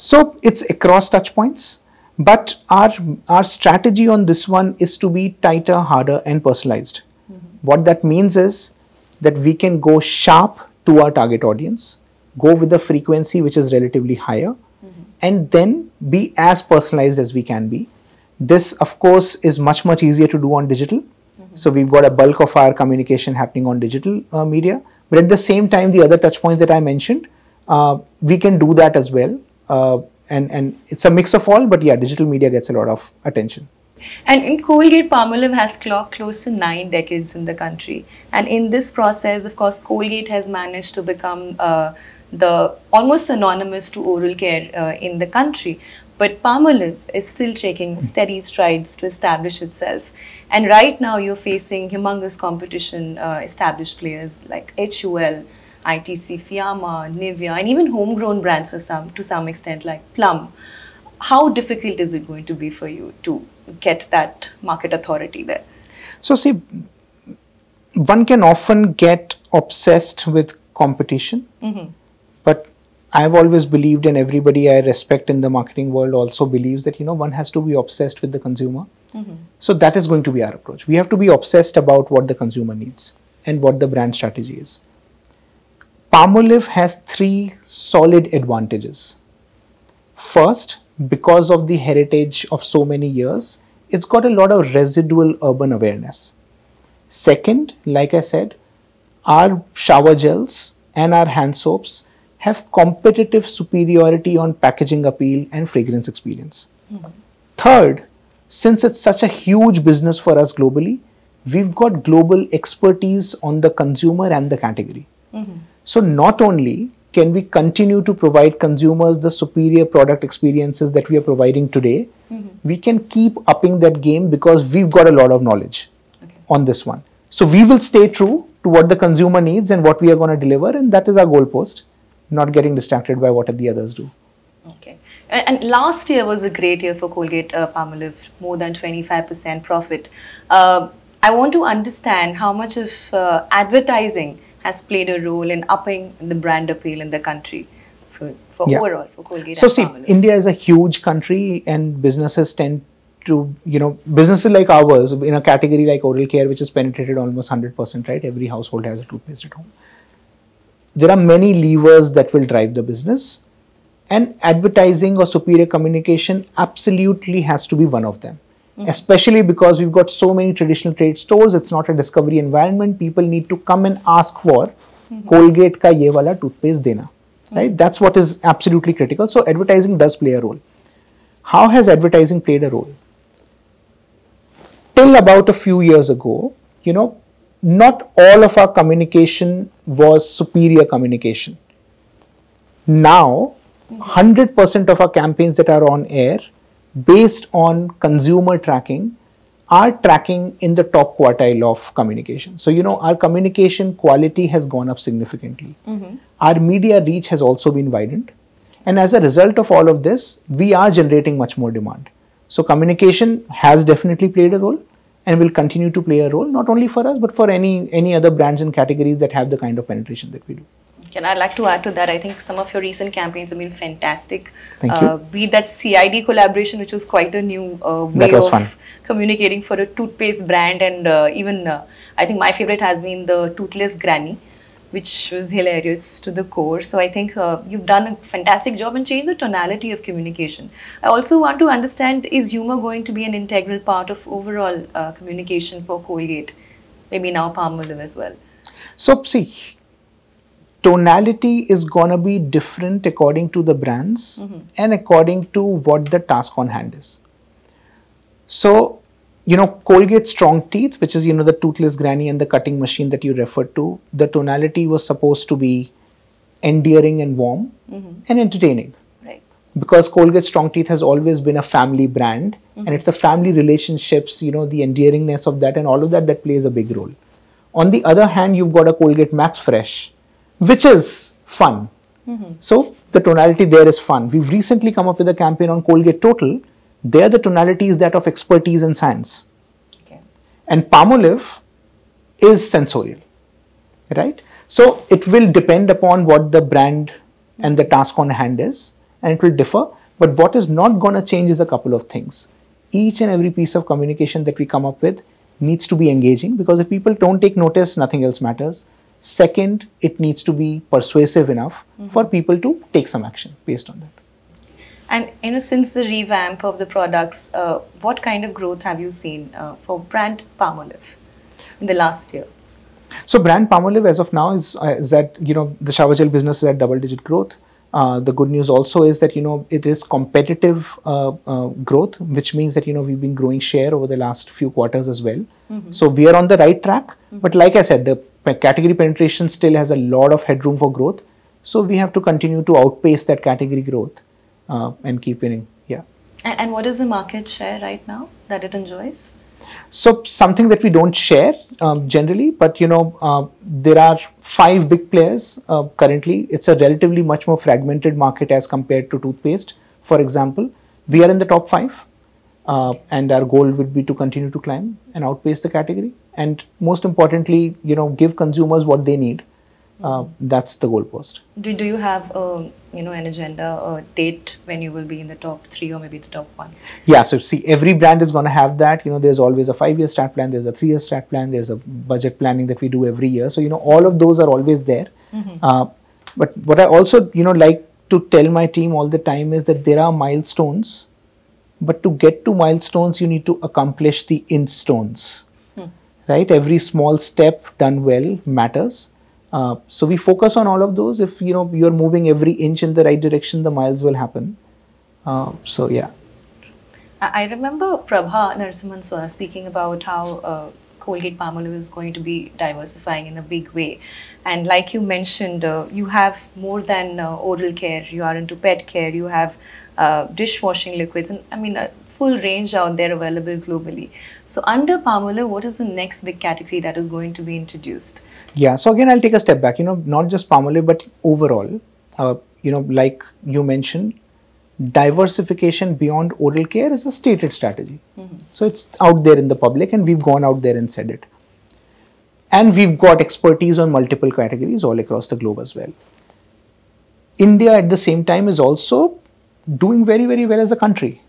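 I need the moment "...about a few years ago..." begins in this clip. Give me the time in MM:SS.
03:05.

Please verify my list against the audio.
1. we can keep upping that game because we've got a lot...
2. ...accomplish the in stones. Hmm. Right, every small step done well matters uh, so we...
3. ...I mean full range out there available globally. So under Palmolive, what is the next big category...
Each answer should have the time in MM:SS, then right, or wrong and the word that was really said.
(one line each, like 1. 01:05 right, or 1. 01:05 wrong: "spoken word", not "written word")
1. 02:02 right
2. 06:33 right
3. 07:01 right.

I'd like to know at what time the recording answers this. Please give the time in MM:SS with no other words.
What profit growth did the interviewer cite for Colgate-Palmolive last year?
02:18.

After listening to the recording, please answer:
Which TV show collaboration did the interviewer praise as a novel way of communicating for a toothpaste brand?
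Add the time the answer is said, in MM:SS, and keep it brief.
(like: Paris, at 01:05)
CID, at 03:45.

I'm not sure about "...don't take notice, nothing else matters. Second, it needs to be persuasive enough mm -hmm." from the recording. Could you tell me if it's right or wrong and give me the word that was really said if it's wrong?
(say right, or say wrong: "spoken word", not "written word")
right.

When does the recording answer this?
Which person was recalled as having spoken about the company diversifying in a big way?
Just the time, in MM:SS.
06:47.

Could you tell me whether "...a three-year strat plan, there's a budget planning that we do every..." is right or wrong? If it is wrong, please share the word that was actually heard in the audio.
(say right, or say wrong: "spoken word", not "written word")
right.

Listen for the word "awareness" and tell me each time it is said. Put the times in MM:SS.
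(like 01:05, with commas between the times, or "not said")
01:35.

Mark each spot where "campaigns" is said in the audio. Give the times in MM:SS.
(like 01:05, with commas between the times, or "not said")
03:15, 03:43, 04:45.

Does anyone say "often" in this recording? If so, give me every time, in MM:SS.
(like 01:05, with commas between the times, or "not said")
01:08.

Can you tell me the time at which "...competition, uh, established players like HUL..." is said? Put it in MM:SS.
00:52.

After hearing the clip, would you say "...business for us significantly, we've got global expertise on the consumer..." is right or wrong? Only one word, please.
wrong.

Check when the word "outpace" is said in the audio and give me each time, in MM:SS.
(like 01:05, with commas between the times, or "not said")
05:42, 06:05.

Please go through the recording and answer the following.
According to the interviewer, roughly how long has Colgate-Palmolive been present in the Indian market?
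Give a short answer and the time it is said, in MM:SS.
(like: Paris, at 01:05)
Nine decades, at 00:36.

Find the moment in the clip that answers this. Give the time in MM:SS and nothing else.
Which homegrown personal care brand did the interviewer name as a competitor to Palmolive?
01:00.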